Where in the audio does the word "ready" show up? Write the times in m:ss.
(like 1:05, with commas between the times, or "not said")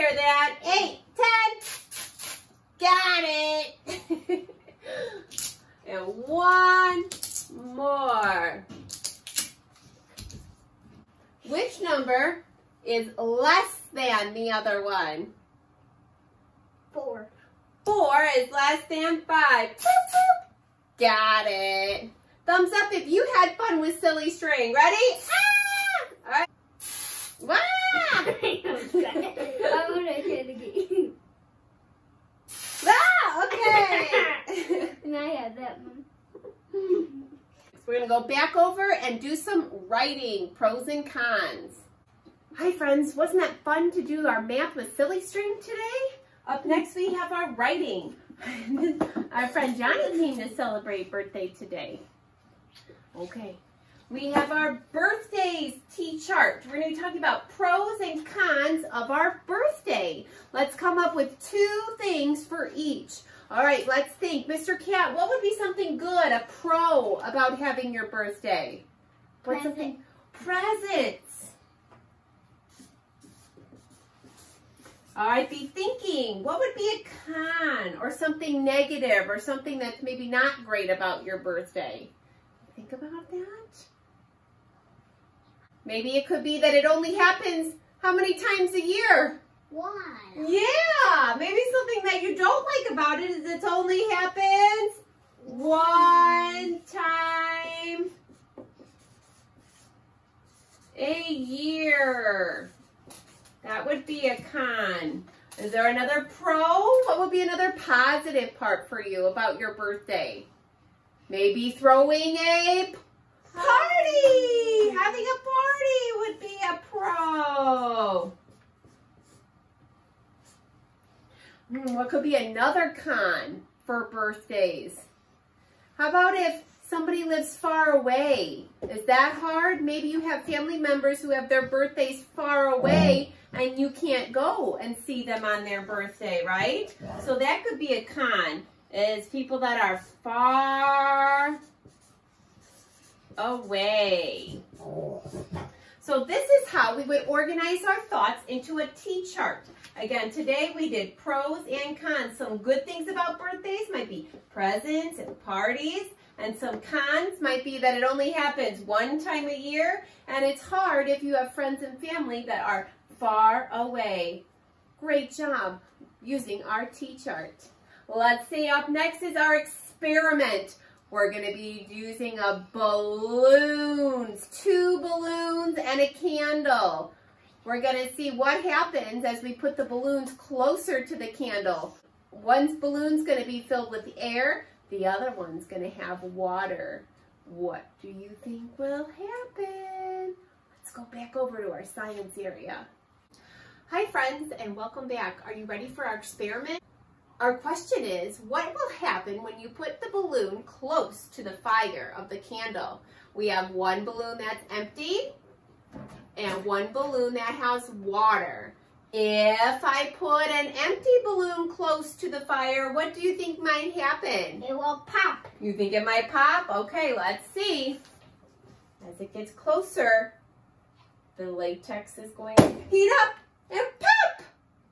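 0:24, 3:15.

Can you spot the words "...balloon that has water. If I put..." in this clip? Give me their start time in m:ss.
3:26.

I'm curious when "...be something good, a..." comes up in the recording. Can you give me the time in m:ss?
1:05.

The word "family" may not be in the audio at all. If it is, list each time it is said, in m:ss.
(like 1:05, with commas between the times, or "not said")
2:10, 2:41.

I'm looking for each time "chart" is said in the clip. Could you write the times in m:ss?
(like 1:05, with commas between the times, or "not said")
0:55, 2:28, 2:46.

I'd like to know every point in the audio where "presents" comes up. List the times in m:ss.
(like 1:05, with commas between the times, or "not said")
1:10, 2:34.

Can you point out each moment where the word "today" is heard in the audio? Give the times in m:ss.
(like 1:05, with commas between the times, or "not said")
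0:45, 0:51, 2:30.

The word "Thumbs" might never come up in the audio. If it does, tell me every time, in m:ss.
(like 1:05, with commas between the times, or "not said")
0:22.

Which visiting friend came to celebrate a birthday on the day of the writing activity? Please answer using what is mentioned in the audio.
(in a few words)
Johnny.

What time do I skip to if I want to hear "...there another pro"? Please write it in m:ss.
1:45.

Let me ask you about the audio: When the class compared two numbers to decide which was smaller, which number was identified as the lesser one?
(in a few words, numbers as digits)
4.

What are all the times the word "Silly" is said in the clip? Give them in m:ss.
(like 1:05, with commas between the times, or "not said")
0:23, 0:44.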